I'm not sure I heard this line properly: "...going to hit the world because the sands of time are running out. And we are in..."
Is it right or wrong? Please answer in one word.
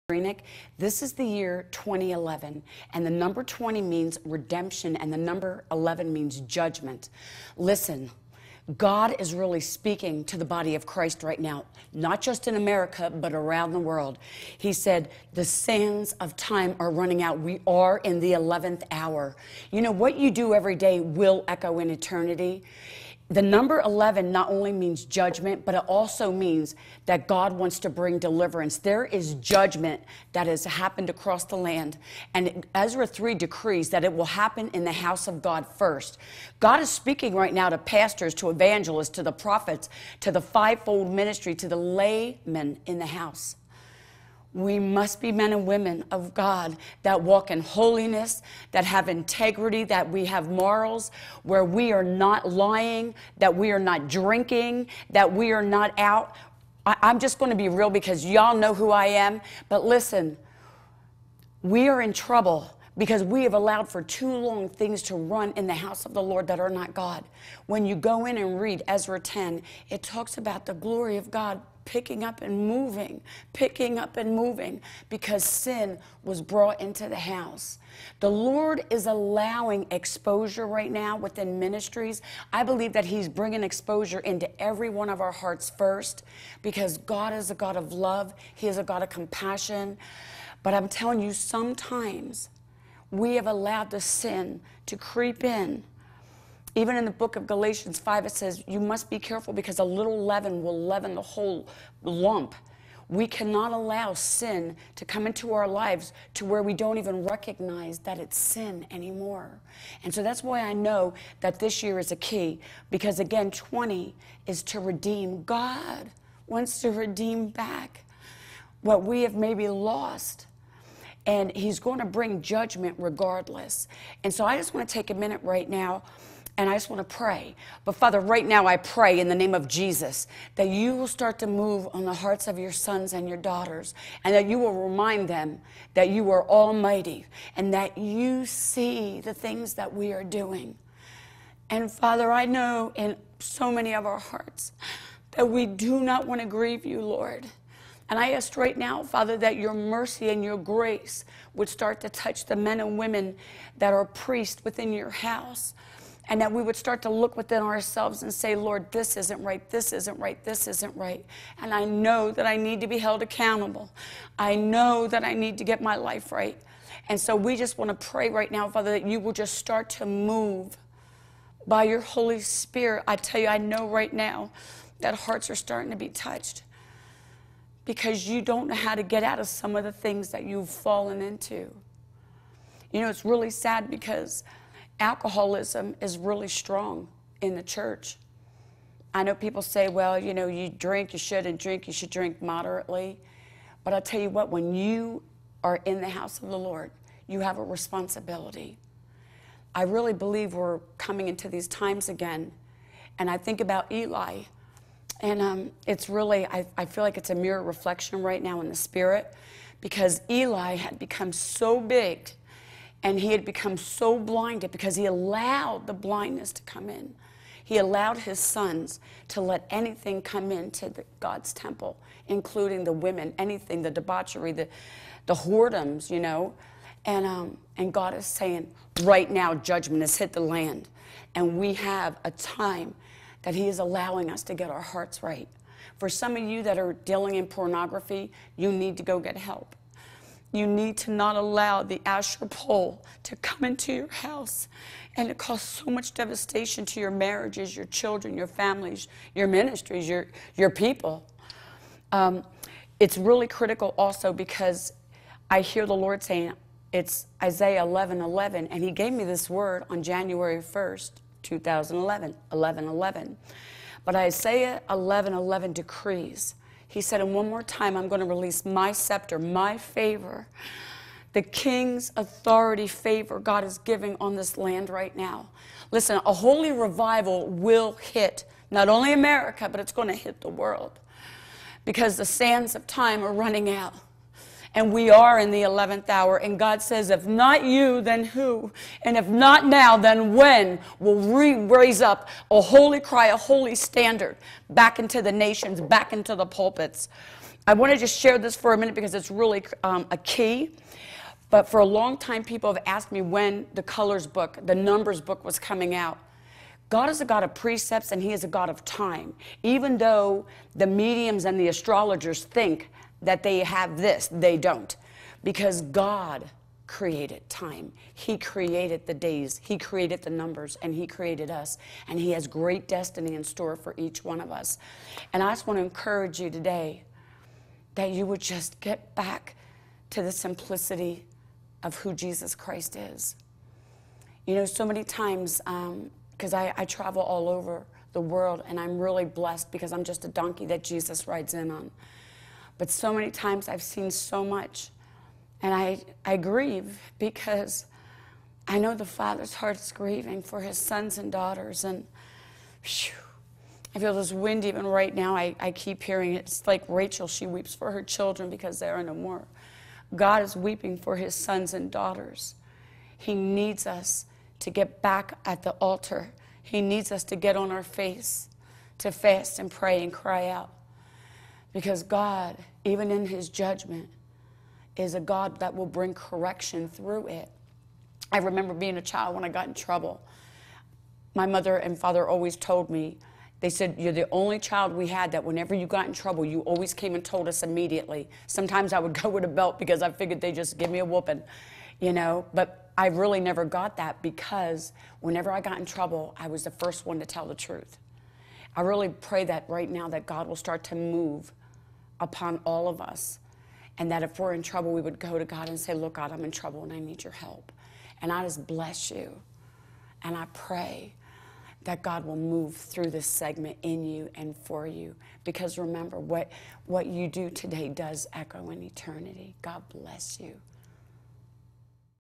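right.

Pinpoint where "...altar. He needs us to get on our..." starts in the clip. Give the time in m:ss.
6:05.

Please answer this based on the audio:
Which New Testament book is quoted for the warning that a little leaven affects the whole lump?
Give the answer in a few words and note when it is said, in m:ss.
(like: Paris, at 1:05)
Galatians 5, at 1:37.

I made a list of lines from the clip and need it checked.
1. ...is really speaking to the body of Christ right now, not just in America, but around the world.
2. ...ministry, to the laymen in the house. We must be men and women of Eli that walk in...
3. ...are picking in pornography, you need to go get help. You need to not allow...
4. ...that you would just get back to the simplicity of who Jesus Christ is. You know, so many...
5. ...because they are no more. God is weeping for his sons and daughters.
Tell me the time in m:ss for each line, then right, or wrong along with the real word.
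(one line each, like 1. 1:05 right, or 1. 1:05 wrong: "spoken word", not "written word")
1. 0:09 right
2. 0:41 wrong: "God", not "Eli"
3. 3:56 wrong: "dealing", not "picking"
4. 5:27 right
5. 5:58 right.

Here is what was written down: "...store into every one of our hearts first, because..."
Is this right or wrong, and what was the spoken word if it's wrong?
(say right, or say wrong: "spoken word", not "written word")
wrong: "exposure", not "store".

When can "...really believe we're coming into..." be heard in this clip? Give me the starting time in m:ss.
3:19.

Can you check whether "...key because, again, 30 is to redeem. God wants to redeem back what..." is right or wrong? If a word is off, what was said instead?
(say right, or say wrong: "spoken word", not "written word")
wrong: "20", not "30".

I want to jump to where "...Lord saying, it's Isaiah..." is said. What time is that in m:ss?
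4:15.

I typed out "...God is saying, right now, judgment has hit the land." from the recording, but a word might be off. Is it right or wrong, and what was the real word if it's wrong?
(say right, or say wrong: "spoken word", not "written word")
right.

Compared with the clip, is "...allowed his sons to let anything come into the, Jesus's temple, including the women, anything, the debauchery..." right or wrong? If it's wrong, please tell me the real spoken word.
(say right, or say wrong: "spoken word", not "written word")
wrong: "God", not "Jesus".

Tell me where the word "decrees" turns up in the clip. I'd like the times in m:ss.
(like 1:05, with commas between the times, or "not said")
0:33, 4:25.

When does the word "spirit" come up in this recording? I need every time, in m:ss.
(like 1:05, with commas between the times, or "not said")
2:52, 3:28.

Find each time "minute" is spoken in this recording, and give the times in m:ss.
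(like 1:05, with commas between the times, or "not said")
2:05, 4:58.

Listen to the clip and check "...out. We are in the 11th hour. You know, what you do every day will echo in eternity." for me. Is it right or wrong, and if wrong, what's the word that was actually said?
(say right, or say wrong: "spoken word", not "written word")
right.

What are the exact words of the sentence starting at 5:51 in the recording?
And whew, I feel this wind even right now.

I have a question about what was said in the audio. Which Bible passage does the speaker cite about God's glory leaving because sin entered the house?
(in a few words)
Ezra 10.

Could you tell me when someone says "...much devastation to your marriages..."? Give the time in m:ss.
4:05.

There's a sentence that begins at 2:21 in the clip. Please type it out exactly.
And Father, I know in so many of our hearts that we do not want to grieve you, Lord.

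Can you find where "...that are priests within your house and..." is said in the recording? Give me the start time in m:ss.
2:33.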